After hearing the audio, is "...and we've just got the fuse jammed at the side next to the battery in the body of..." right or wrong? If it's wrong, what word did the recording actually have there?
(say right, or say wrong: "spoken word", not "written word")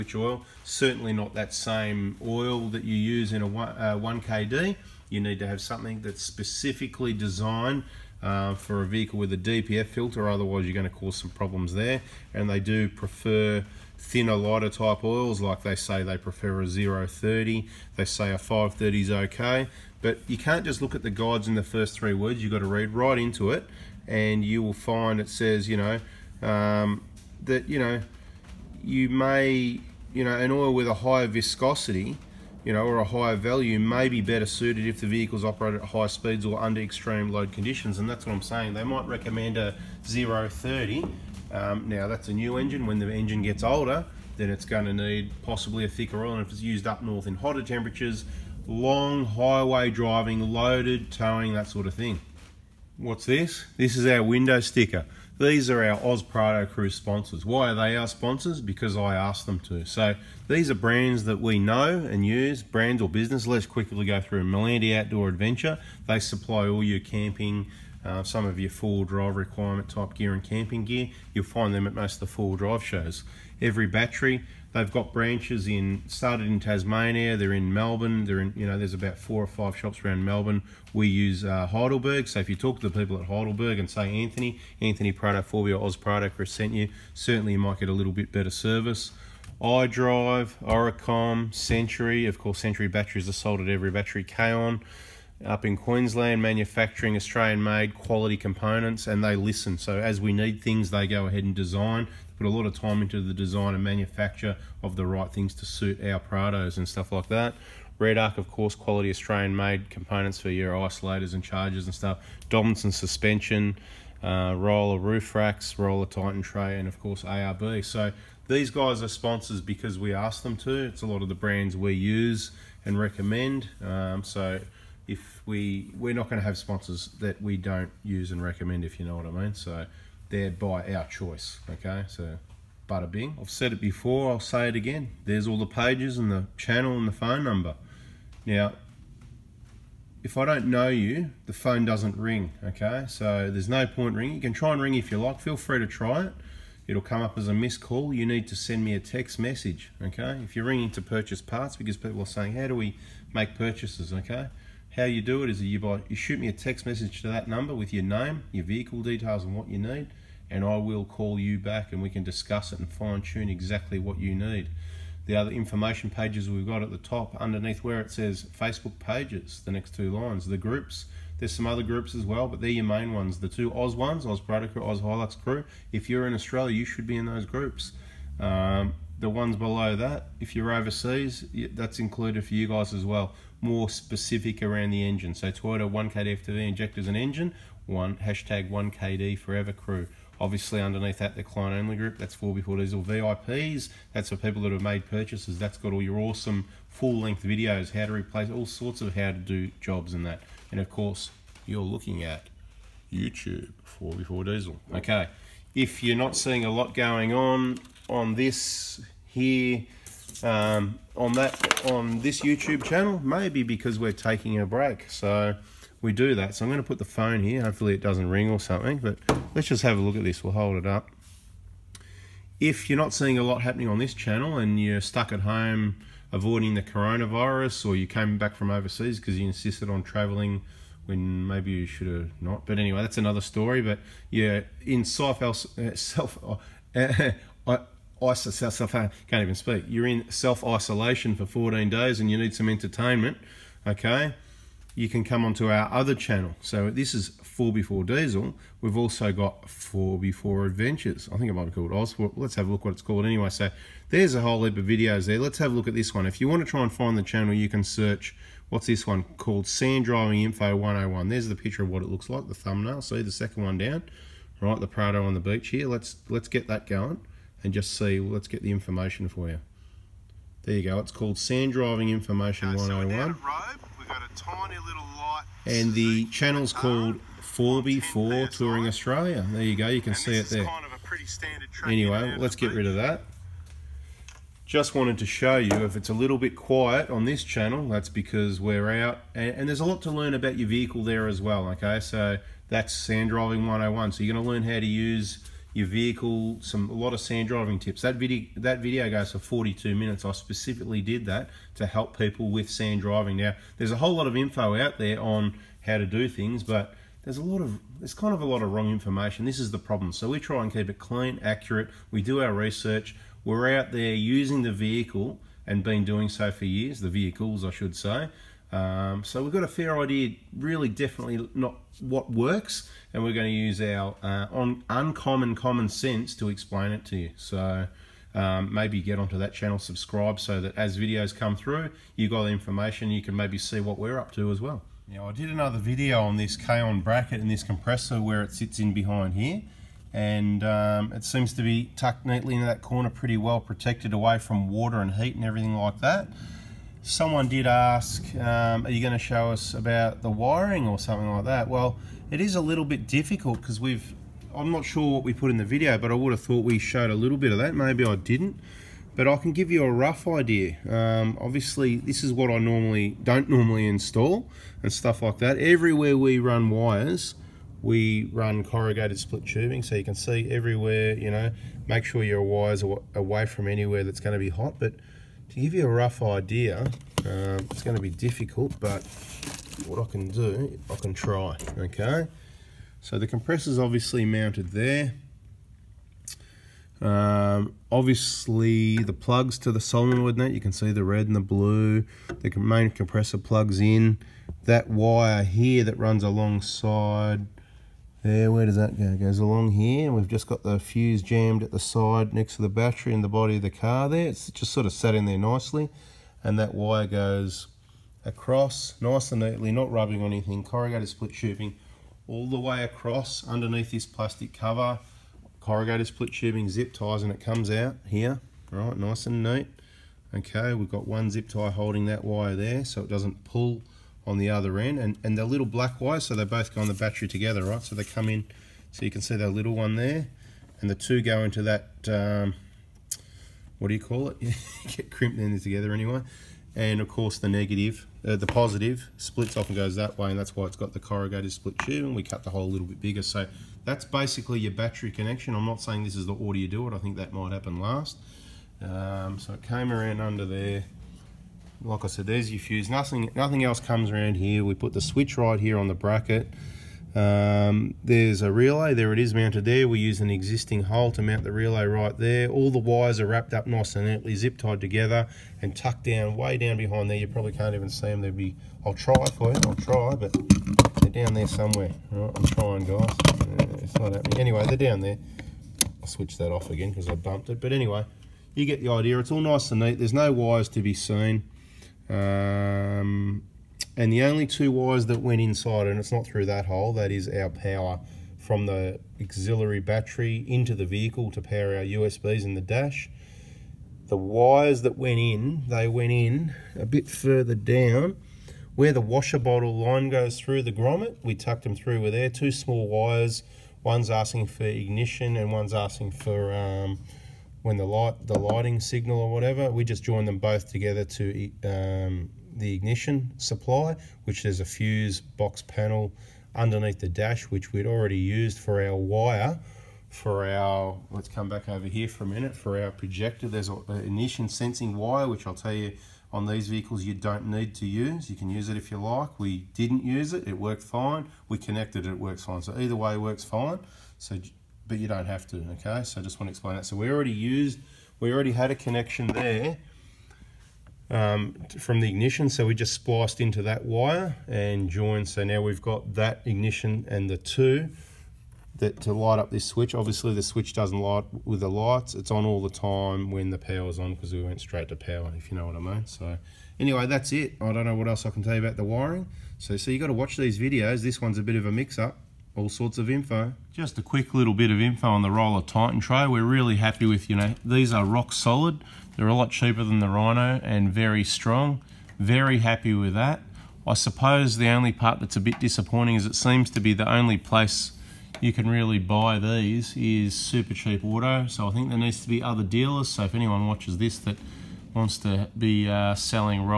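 right.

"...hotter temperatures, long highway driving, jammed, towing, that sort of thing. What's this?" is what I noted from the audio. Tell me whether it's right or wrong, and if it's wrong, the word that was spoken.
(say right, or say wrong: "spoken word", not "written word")
wrong: "loaded", not "jammed".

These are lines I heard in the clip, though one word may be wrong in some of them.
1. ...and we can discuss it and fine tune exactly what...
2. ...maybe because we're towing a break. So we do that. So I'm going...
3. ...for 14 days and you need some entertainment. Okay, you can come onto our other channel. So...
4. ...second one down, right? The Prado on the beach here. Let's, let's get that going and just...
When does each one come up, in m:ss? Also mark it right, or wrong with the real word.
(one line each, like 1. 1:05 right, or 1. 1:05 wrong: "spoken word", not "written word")
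1. 2:41 right
2. 3:33 wrong: "taking", not "towing"
3. 4:01 right
4. 4:23 right.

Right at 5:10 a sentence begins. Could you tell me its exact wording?
So we try and keep it clean, accurate.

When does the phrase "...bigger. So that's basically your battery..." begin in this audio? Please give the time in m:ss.
7:23.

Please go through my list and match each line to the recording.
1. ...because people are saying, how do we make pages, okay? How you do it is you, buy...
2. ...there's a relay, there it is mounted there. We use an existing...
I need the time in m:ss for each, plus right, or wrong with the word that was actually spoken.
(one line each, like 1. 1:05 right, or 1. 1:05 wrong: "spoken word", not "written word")
1. 2:31 wrong: "purchases", not "pages"
2. 7:38 right.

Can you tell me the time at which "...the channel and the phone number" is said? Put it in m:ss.
2:16.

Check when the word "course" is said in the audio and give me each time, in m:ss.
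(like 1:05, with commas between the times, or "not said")
1:32, 1:48, 1:56, 3:20, 7:17.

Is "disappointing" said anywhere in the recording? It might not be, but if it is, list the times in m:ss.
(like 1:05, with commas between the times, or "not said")
9:35.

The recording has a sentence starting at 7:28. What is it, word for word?
Um, so it came around under there.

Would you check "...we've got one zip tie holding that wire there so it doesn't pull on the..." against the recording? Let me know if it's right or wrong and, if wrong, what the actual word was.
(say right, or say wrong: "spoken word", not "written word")
right.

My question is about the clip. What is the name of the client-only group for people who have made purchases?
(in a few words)
4B4 Diesel VIPs.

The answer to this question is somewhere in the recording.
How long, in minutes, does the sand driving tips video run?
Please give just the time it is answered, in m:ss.
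4:59.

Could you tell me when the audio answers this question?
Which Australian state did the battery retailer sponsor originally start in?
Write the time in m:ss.
1:16.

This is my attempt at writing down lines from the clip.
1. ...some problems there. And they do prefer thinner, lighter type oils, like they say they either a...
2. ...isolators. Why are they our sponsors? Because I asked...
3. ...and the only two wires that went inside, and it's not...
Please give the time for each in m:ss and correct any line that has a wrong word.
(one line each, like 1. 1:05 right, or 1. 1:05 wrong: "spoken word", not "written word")
1. 0:11 wrong: "prefer", not "either"
2. 0:56 wrong: "sponsors", not "isolators"
3. 8:03 right.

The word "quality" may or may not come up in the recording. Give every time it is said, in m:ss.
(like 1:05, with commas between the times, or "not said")
1:37, 1:48.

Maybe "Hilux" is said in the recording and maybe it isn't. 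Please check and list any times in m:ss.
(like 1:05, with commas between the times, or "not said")
2:55.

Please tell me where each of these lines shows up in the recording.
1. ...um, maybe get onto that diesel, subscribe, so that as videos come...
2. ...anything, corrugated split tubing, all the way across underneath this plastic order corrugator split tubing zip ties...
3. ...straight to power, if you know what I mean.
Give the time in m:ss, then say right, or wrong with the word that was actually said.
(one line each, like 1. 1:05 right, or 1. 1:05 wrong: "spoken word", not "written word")
1. 5:28 wrong: "channel", not "diesel"
2. 6:50 wrong: "cover", not "order"
3. 9:14 right.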